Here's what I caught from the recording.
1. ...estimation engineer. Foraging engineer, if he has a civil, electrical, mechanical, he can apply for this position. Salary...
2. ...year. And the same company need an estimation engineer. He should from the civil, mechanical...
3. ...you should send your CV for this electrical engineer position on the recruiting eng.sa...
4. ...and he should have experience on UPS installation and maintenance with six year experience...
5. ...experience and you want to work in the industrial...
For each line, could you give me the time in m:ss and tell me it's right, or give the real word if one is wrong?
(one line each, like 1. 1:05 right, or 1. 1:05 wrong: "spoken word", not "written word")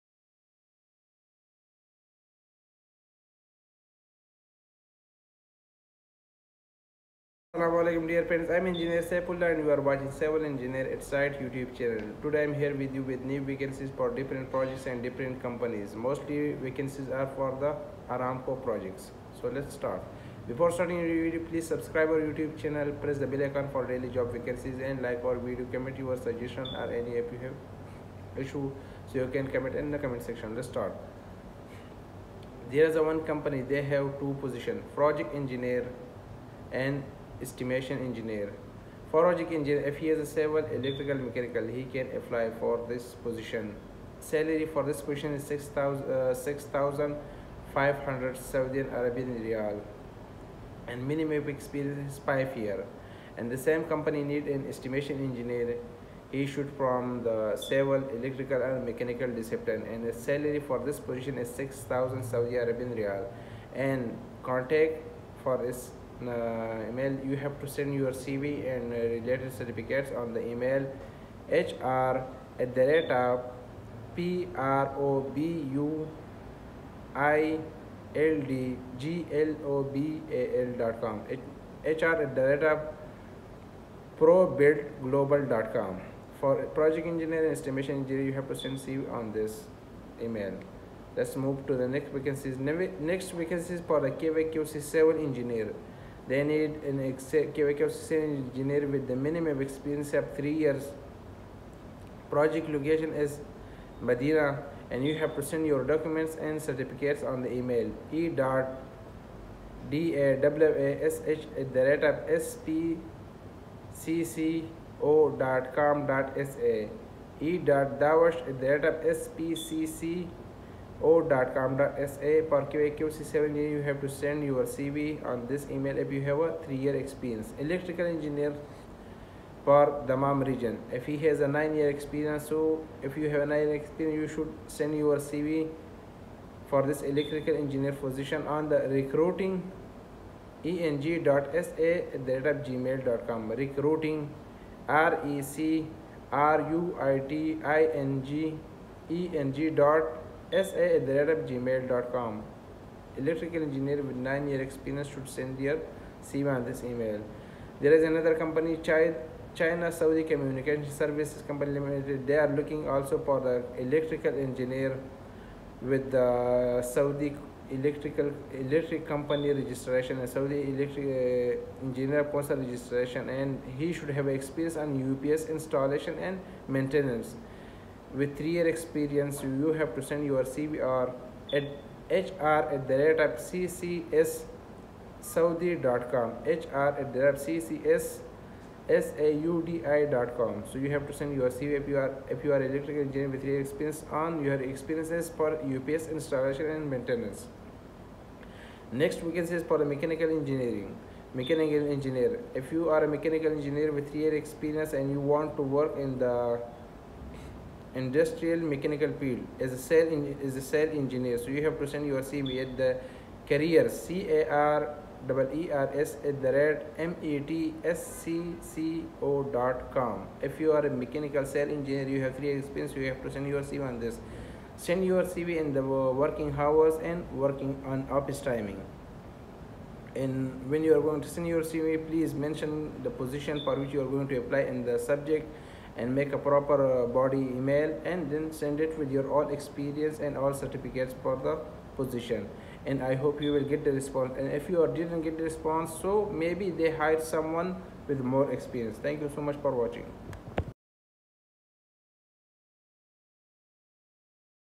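1. 0:37 right
2. 0:52 wrong: "electrical", not "mechanical"
3. 2:14 right
4. 2:53 wrong: "three", not "six"
5. 3:24 right.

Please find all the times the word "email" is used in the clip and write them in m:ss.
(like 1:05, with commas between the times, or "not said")
1:06, 1:10, 1:30, 1:47, 2:05, 2:36, 3:57.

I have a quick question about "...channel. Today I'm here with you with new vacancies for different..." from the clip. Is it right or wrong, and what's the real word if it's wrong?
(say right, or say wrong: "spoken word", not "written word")
right.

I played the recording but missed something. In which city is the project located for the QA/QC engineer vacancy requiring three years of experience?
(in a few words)
Medina.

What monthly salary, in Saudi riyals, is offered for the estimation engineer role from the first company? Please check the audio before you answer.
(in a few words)
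6,000.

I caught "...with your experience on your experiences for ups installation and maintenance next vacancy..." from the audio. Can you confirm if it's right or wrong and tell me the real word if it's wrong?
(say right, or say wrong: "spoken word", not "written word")
right.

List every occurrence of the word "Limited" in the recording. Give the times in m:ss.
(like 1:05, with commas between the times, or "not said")
2:41.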